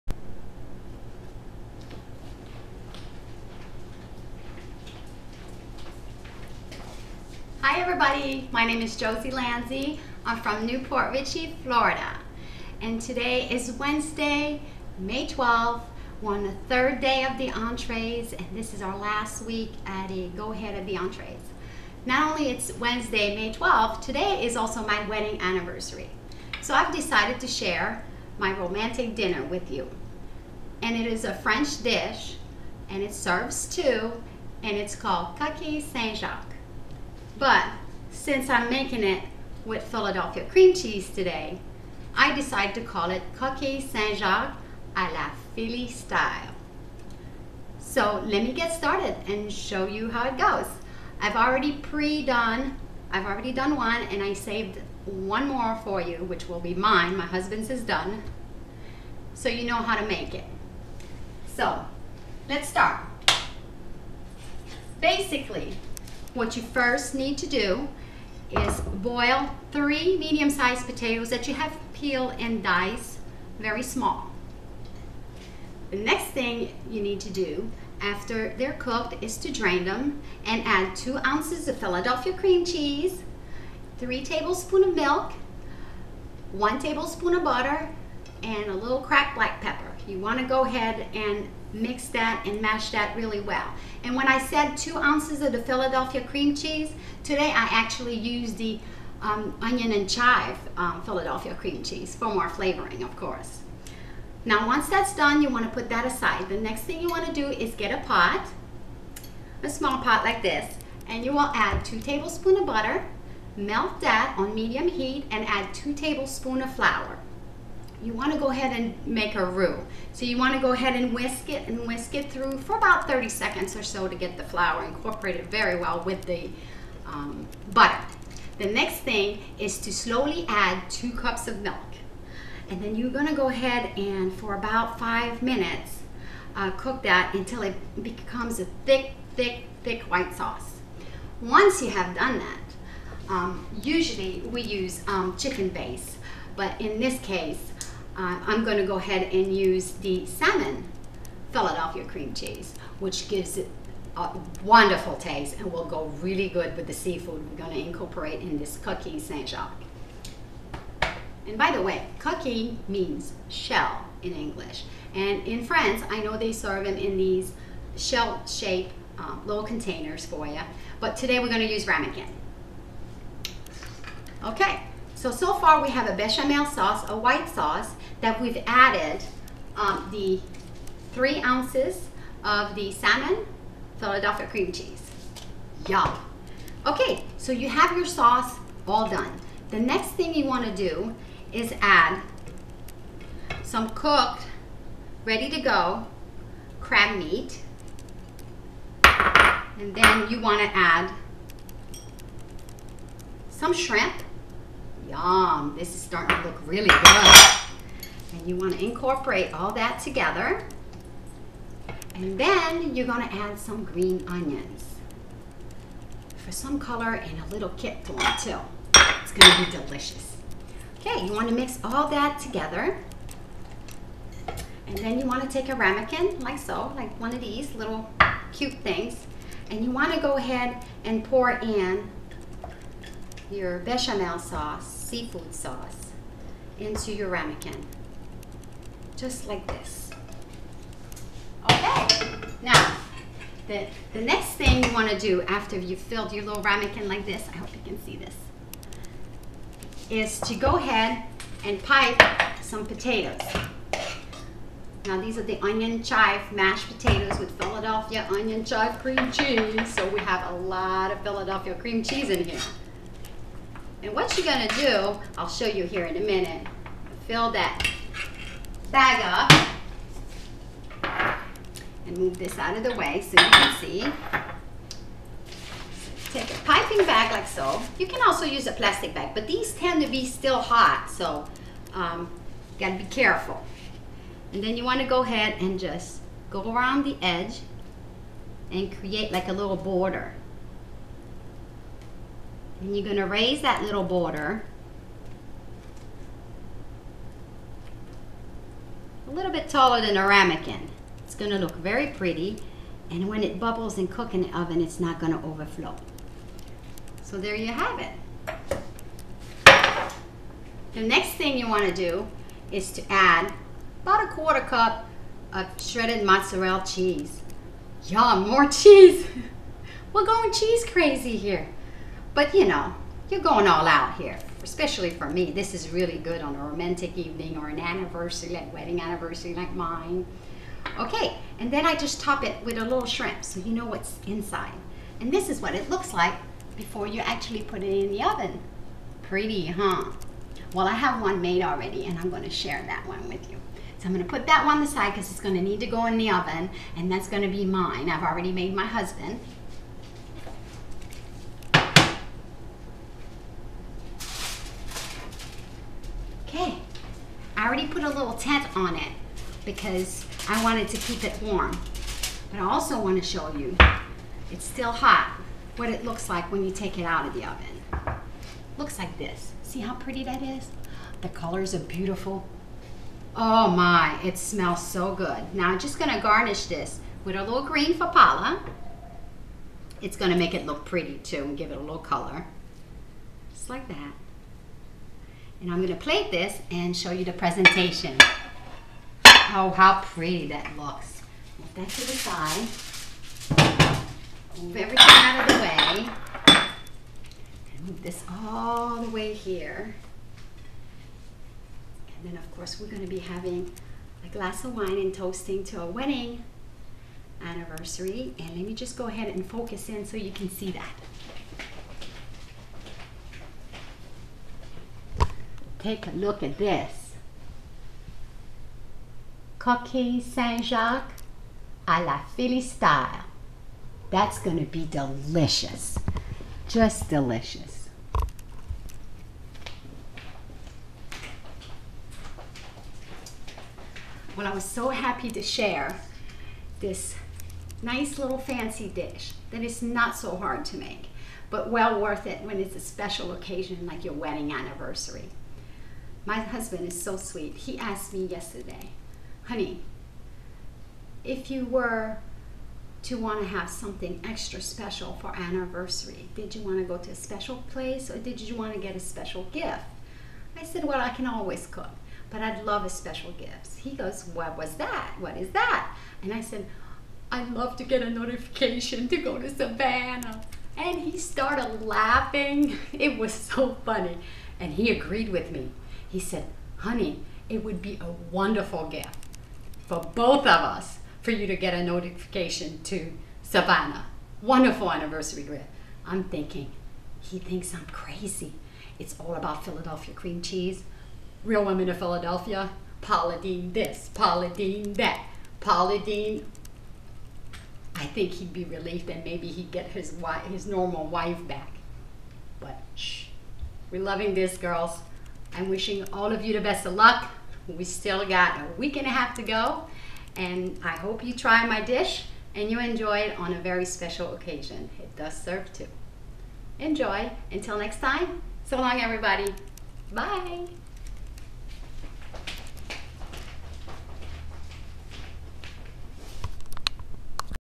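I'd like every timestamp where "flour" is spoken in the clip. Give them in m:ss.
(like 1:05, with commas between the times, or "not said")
1:56, 2:04.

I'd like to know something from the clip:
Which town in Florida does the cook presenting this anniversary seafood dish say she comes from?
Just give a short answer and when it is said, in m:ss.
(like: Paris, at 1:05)
Newport Richey, at 0:10.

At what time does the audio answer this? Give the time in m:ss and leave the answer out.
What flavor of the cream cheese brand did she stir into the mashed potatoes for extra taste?
1:39.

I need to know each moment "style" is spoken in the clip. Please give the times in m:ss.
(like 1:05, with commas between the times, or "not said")
0:45, 7:02.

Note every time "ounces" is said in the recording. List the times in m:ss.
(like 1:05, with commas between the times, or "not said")
1:21, 1:34, 3:01.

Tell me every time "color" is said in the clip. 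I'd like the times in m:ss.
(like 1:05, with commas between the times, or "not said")
3:36, 6:11, 6:21.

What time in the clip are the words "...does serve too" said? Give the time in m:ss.
8:35.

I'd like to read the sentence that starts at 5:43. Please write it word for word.
So I'm gonna put that one aside because it's gonna need to go in the oven and that's gonna be mine.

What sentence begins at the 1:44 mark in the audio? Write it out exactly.
Now once that's done, you want to put that aside.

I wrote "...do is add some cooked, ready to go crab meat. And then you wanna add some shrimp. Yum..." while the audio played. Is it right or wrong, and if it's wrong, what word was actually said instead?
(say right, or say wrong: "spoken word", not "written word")
right.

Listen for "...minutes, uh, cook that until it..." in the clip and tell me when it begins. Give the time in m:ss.
2:15.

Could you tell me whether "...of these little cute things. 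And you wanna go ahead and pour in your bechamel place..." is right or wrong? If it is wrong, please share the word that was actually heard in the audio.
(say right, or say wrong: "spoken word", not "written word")
wrong: "sauce", not "place".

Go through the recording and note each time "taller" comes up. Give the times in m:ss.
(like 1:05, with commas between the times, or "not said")
4:59.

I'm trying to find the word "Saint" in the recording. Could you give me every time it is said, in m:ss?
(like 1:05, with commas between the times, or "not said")
0:35, 0:43, 2:39, 7:00.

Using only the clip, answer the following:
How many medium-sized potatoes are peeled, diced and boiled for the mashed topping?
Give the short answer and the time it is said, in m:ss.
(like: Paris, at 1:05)
3, at 1:09.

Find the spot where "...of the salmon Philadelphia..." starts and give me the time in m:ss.
3:02.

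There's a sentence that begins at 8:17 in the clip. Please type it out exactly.
I think he'd be relieved and maybe he'd get his wife, his normal wife back.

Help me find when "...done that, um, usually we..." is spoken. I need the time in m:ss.
2:22.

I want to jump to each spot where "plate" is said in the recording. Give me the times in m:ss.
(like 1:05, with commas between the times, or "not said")
6:25.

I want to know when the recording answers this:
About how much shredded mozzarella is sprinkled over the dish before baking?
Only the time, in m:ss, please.
5:14.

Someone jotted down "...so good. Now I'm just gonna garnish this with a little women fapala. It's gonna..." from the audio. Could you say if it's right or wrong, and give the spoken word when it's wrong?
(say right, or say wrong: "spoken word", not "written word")
wrong: "green", not "women".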